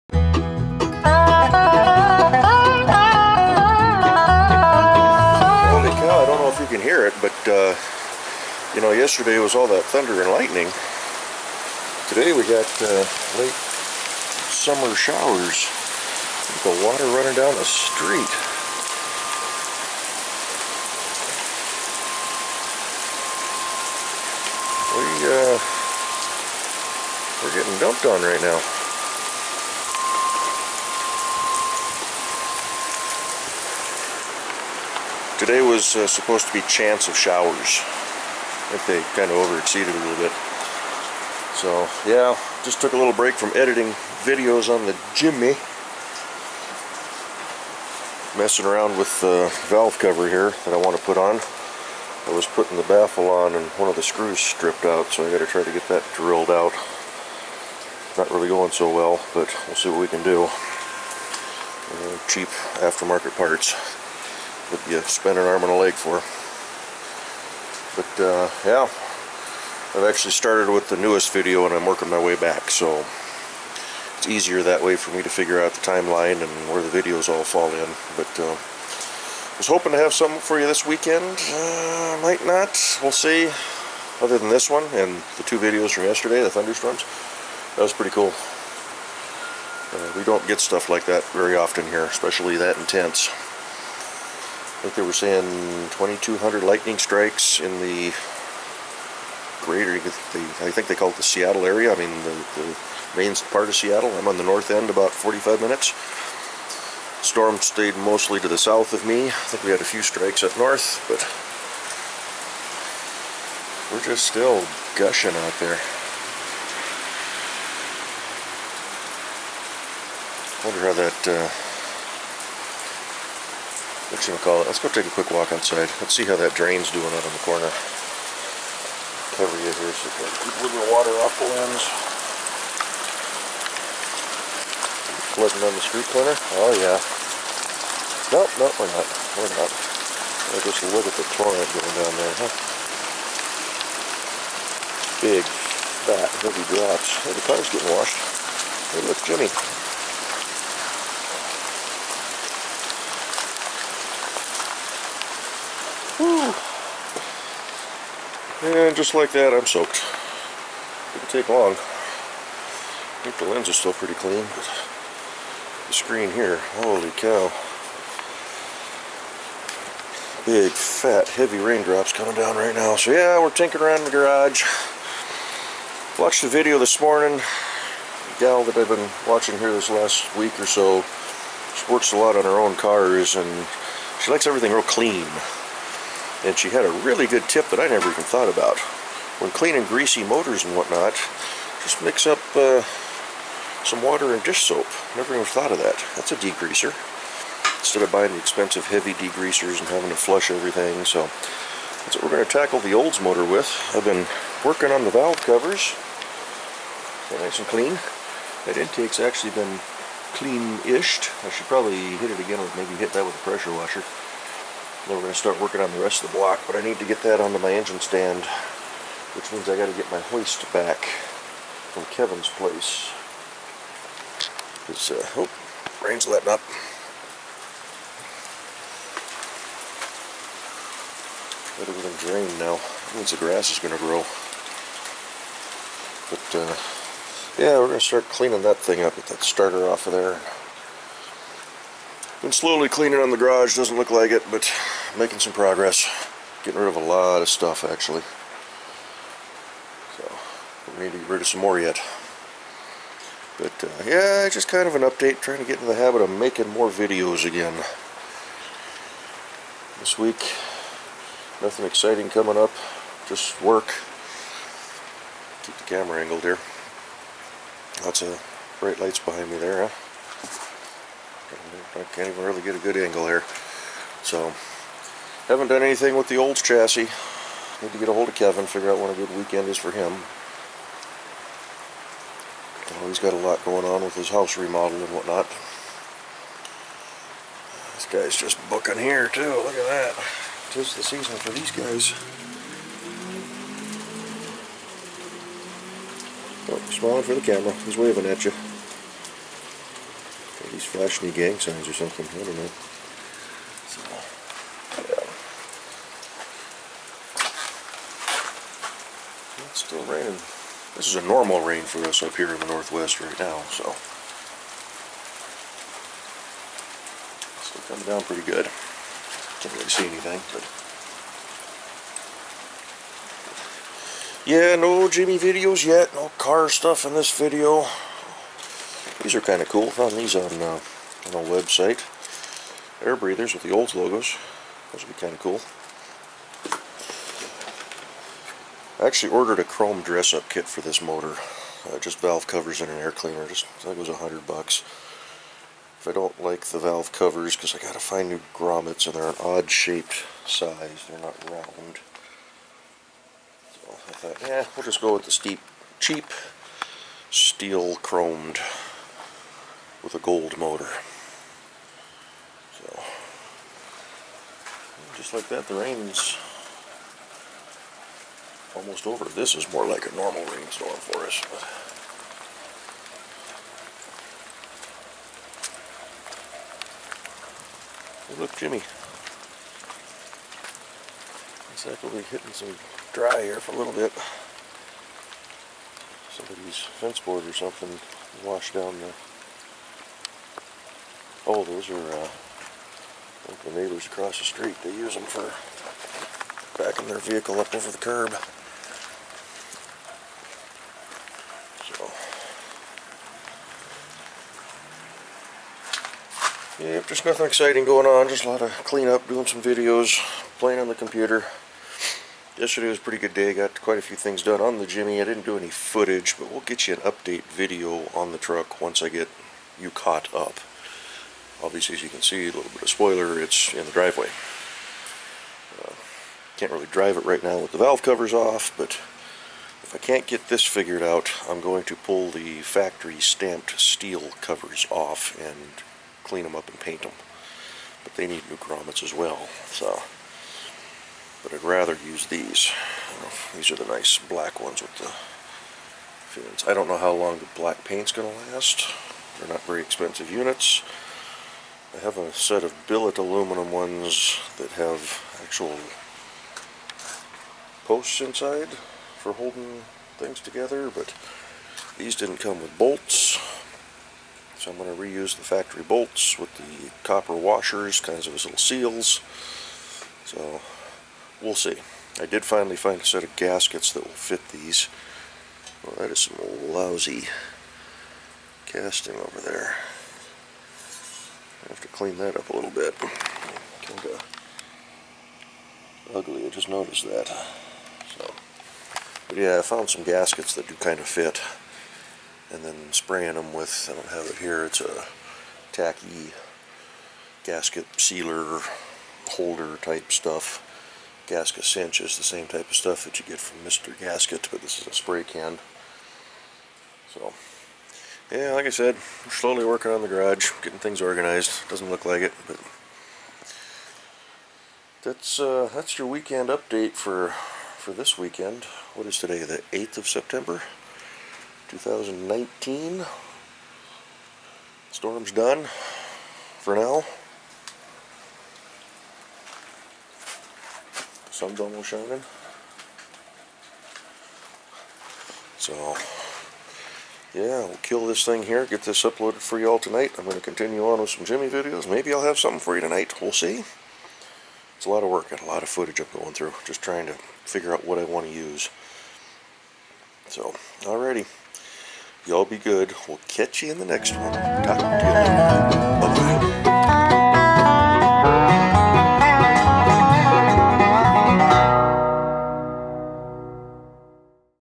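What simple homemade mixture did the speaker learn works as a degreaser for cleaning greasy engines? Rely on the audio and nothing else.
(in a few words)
Water and dish soap.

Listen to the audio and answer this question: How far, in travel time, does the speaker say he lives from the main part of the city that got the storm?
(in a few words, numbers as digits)
45 minutes.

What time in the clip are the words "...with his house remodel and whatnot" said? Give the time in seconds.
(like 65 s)
284 s.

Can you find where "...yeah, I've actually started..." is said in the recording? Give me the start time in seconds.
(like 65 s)
68 s.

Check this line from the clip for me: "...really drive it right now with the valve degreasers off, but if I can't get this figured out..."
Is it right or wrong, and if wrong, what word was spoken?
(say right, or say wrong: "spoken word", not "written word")
wrong: "covers", not "degreasers".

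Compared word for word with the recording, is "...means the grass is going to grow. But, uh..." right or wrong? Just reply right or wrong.
right.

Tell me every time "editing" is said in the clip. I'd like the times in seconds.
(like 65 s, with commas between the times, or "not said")
43 s.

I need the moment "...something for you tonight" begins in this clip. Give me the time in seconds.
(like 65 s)
542 s.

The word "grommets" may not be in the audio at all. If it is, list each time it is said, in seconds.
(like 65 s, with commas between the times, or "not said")
348 s, 438 s.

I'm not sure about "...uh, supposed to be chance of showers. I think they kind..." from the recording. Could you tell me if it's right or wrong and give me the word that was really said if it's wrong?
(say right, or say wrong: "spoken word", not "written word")
right.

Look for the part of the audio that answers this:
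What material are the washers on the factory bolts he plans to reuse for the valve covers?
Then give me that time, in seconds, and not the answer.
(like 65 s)
467 s.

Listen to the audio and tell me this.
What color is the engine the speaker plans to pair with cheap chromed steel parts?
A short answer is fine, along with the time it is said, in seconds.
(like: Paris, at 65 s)
Gold, at 360 s.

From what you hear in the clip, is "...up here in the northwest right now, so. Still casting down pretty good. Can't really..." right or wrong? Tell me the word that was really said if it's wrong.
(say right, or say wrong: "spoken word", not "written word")
wrong: "coming", not "casting".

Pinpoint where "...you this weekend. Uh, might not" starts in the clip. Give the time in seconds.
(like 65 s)
80 s.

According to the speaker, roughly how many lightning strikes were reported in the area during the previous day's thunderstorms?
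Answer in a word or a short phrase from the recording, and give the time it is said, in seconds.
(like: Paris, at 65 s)
2,200, at 95 s.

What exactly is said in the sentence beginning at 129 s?
Cover you here so you keep a little water off the lens.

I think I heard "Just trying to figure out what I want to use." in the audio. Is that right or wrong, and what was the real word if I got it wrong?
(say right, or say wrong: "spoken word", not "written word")
right.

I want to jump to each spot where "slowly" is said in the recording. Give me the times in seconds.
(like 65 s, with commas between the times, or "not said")
242 s, 509 s.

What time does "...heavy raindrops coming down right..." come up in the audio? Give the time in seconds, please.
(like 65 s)
171 s.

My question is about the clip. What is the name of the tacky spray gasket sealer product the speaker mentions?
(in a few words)
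Gasgacinch.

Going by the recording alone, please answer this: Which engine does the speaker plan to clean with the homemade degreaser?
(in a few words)
The Olds motor.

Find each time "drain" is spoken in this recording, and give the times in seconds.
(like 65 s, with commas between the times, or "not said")
126 s, 232 s.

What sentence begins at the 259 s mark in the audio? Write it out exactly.
This week, nothing exciting coming up, just work.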